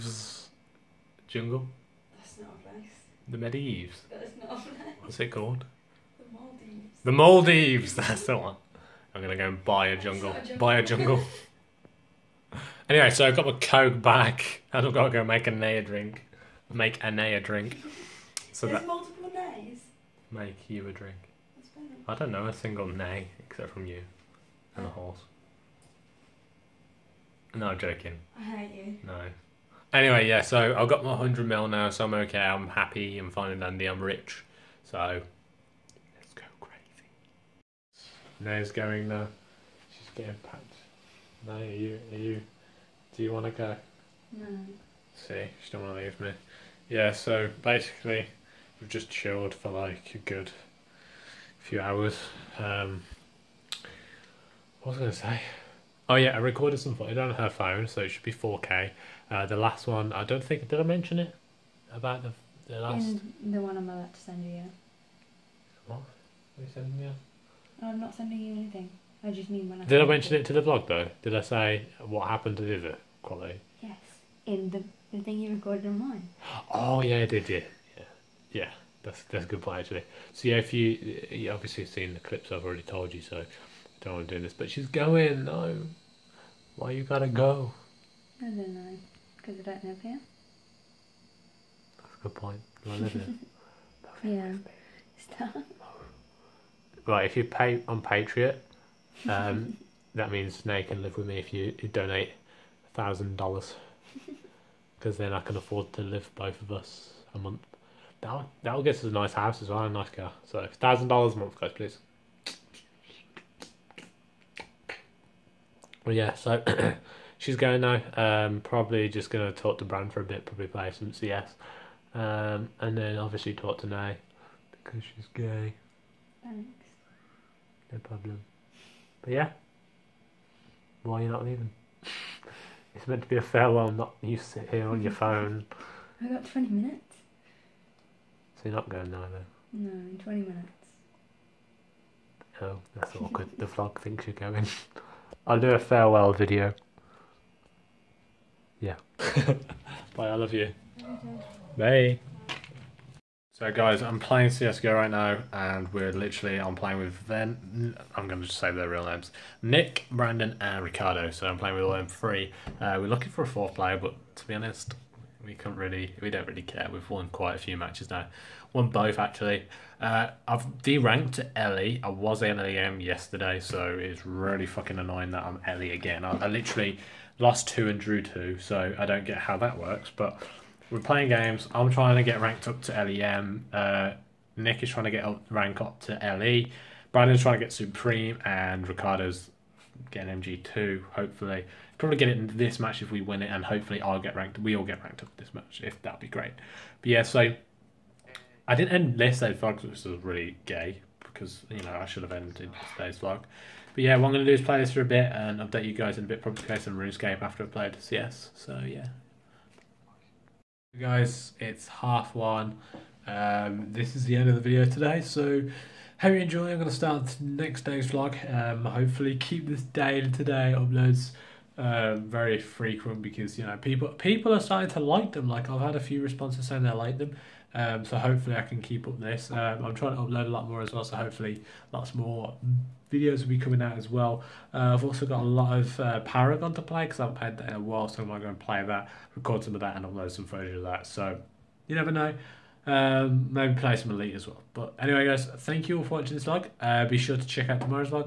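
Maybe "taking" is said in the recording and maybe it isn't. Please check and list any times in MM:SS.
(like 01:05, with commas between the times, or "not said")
not said.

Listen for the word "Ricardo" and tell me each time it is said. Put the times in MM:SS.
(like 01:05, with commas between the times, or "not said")
02:40, 03:08.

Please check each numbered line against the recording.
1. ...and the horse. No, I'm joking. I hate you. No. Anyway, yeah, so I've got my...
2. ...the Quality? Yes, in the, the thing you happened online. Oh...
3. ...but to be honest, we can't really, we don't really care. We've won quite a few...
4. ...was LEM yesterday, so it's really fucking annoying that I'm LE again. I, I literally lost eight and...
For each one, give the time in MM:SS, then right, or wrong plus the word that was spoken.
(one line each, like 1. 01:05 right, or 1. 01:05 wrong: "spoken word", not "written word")
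1. 00:24 right
2. 01:12 wrong: "recorded", not "happened"
3. 02:43 right
4. 02:52 wrong: "two", not "eight".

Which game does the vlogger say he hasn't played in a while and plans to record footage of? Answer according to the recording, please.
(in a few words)
Paragon.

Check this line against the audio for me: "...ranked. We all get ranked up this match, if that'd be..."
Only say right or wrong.
right.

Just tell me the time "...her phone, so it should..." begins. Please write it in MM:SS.
00:57.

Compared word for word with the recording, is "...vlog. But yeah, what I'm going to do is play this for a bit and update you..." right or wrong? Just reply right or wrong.
right.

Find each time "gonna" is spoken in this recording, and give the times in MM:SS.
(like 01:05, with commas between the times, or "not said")
00:09, 01:59.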